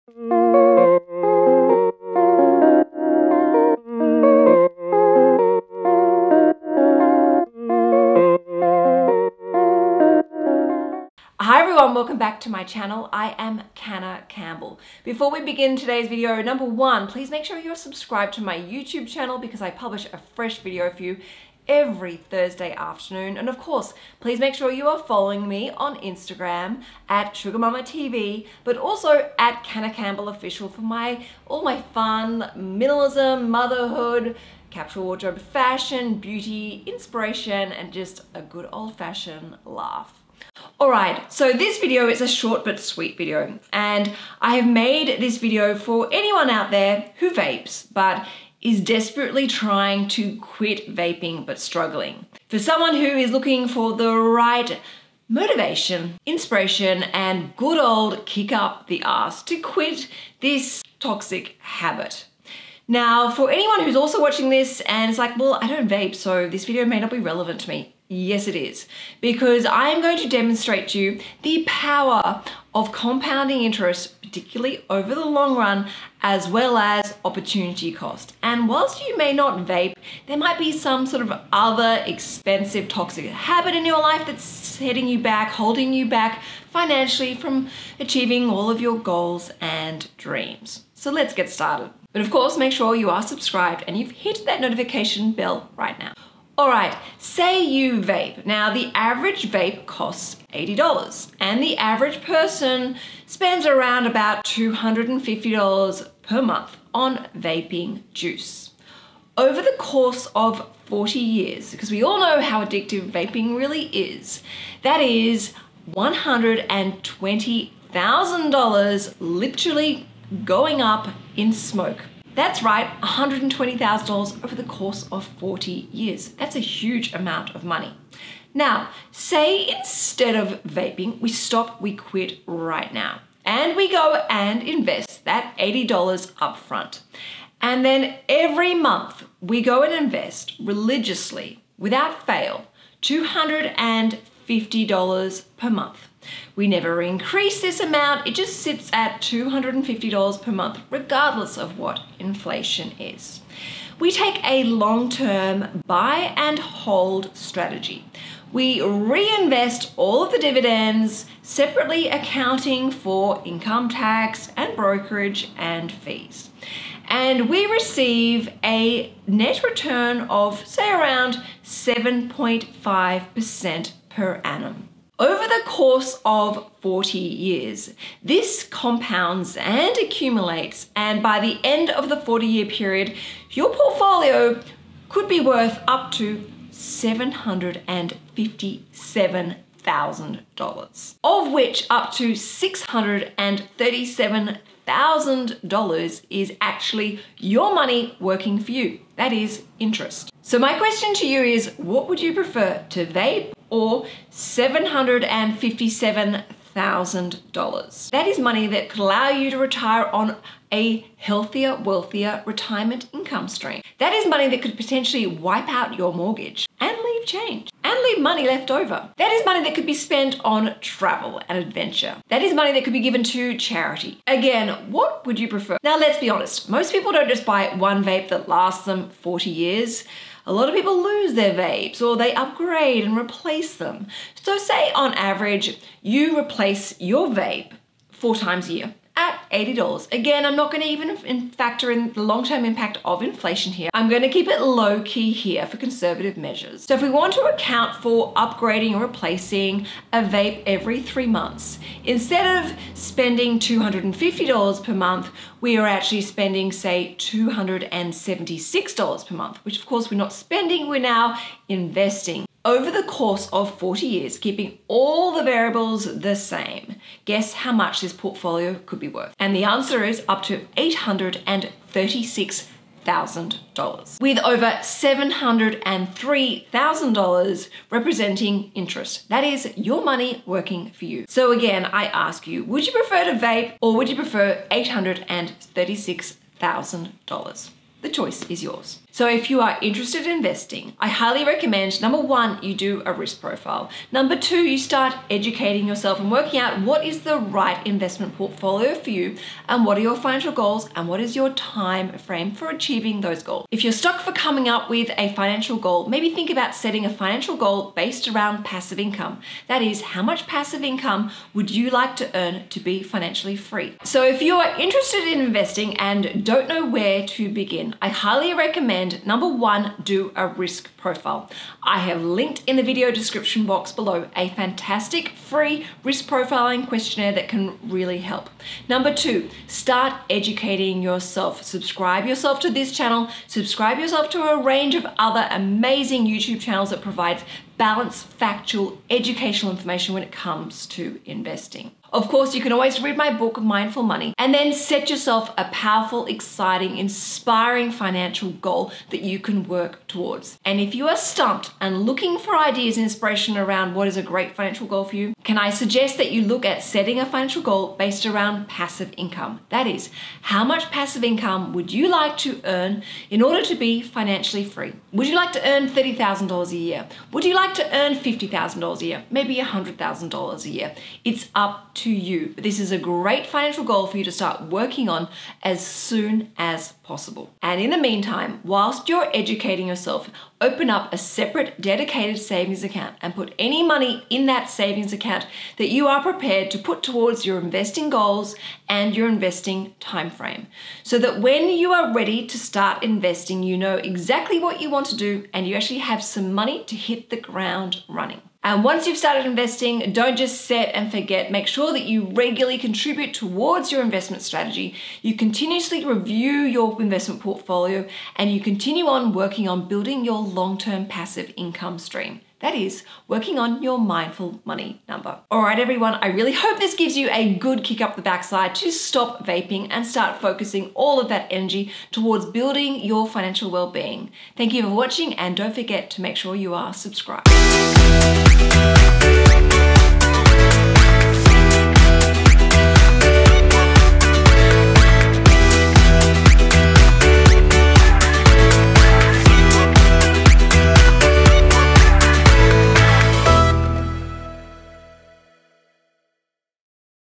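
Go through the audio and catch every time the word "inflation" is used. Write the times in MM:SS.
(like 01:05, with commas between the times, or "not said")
02:32, 04:03.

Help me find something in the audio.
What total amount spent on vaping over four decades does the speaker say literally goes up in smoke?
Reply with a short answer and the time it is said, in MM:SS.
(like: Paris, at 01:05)
$120,000, at 01:55.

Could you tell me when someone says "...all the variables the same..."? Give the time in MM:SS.
04:24.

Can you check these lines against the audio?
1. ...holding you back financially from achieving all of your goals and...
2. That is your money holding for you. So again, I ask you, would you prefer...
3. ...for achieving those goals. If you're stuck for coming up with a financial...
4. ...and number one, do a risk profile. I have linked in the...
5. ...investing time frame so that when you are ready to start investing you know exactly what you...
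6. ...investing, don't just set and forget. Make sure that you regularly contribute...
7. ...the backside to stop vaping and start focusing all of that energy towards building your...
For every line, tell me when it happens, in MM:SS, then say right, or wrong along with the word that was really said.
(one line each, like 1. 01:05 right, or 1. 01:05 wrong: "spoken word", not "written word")
1. 01:25 right
2. 04:39 wrong: "working", not "holding"
3. 05:02 right
4. 05:19 right
5. 06:29 right
6. 06:39 right
7. 06:58 right.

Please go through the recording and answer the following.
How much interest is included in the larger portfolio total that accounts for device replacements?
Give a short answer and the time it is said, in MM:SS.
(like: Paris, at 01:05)
$703,000, at 04:34.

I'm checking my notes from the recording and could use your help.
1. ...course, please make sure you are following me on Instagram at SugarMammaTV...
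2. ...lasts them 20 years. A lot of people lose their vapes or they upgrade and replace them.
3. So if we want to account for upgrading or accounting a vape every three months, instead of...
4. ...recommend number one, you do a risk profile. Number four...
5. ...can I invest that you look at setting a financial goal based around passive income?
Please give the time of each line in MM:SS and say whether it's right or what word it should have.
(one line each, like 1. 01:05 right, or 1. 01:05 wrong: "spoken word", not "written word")
1. 00:23 right
2. 03:48 wrong: "40", not "20"
3. 04:06 wrong: "replacing", not "accounting"
4. 04:51 wrong: "two", not "four"
5. 05:55 wrong: "suggest", not "invest".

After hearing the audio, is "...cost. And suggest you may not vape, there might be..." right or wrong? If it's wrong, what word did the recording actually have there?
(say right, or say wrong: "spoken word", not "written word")
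wrong: "whilst", not "suggest".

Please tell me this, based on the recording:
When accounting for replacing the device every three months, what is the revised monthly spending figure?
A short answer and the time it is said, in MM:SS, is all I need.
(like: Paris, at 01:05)
$276, at 04:17.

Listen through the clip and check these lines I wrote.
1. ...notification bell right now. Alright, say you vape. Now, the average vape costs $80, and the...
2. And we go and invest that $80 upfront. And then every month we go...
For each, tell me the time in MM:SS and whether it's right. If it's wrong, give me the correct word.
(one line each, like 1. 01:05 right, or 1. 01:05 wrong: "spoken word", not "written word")
1. 01:34 right
2. 02:13 right.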